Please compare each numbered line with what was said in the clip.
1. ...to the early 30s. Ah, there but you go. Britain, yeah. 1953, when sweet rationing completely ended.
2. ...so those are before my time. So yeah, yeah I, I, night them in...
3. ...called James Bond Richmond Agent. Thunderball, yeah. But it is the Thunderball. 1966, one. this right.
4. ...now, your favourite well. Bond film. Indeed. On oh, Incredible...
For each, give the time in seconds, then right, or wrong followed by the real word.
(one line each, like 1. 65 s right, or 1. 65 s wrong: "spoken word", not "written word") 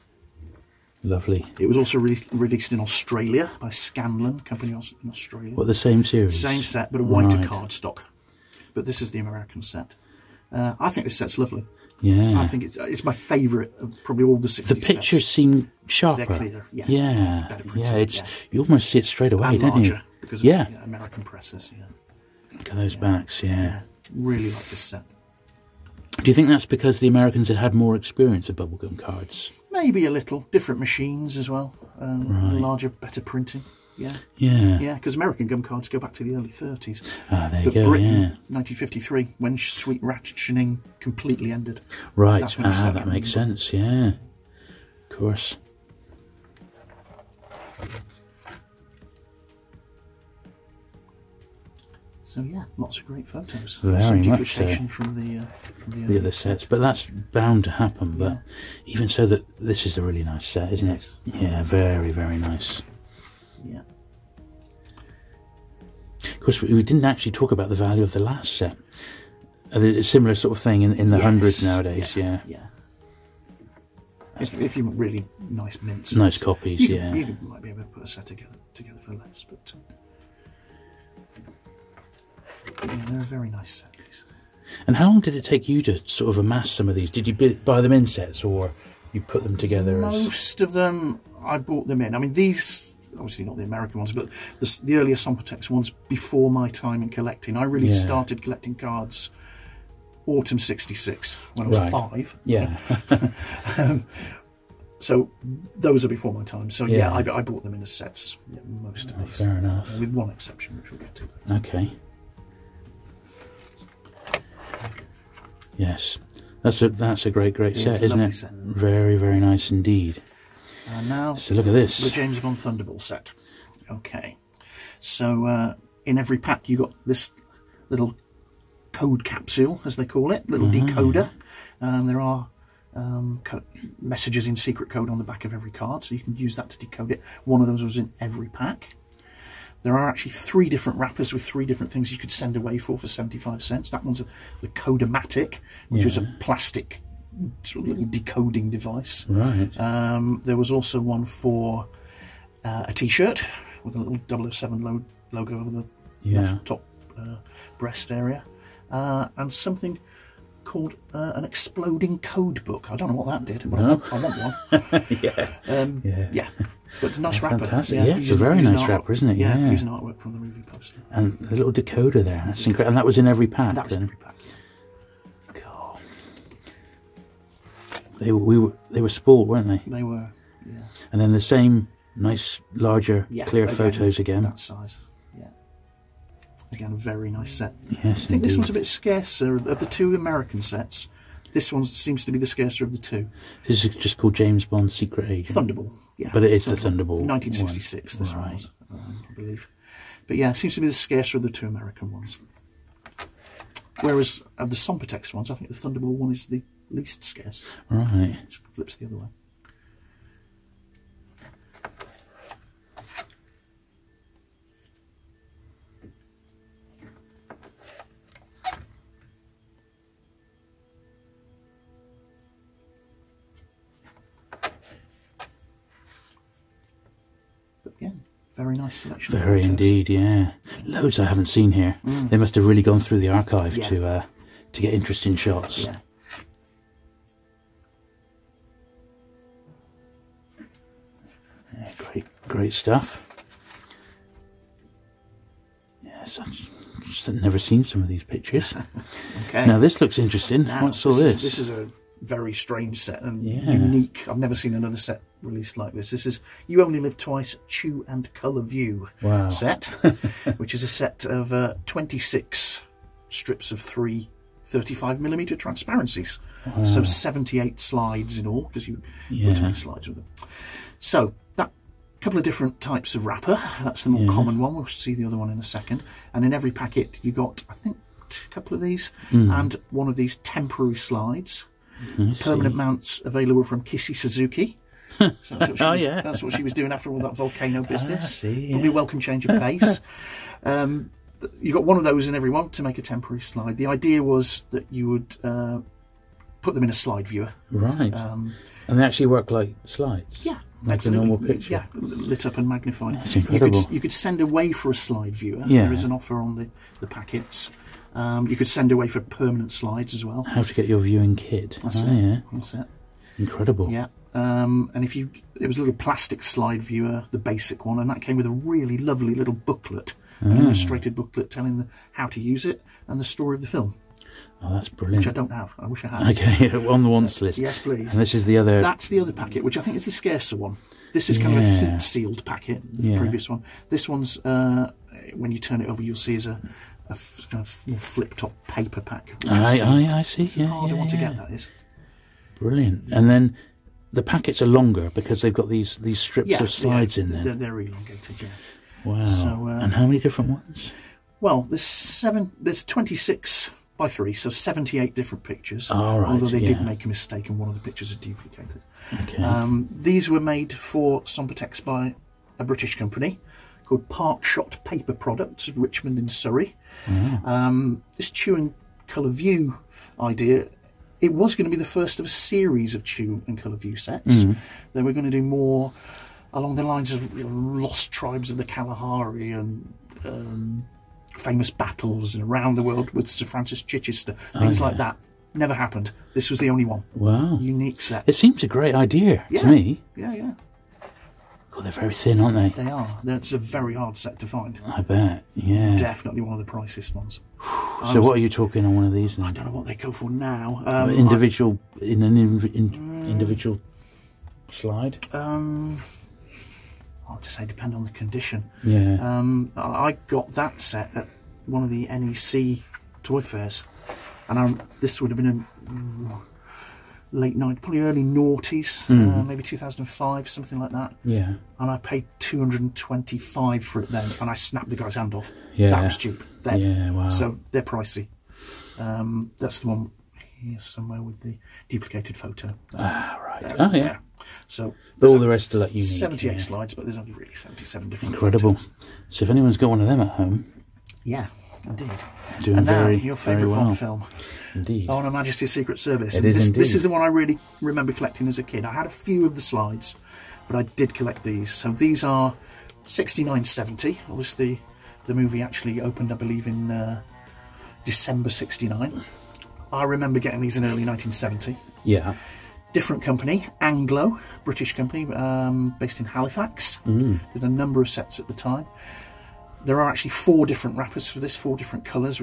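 1. 36 s right
2. 104 s wrong: "bought", not "night"
3. 194 s wrong: "Secret", not "Richmond"
4. 442 s wrong: "Her", not "Incredible".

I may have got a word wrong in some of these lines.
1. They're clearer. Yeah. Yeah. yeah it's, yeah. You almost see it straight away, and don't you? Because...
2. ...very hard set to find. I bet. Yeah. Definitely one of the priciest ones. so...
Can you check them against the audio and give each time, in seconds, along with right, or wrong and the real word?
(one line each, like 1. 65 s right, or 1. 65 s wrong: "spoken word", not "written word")
1. 16 s right
2. 393 s right.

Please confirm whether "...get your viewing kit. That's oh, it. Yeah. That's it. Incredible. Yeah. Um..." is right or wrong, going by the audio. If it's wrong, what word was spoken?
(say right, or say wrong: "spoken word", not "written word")
right.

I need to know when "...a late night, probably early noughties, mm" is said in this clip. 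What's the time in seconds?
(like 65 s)
416 s.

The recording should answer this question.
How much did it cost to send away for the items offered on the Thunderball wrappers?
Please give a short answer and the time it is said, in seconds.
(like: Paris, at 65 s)
75 cents, at 143 s.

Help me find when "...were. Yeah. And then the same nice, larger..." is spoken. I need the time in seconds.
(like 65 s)
180 s.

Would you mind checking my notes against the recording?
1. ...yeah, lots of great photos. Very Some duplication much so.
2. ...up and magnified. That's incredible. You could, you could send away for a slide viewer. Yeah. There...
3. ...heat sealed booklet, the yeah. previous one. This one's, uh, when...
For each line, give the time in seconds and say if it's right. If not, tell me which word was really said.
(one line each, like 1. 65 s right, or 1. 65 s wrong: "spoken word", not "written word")
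1. 52 s right
2. 302 s right
3. 331 s wrong: "packet", not "booklet".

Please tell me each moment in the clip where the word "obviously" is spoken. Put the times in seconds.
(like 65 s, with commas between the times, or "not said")
93 s, 454 s.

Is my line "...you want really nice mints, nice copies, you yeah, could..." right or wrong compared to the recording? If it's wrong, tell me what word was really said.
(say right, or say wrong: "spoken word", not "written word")
right.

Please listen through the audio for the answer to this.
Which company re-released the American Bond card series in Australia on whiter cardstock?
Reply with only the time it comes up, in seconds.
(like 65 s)
3 s.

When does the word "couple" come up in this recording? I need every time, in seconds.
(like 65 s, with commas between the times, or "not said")
272 s, 278 s.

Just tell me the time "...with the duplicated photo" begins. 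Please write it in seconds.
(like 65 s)
431 s.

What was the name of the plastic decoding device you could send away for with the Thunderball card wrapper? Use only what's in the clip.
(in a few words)
Codomatic.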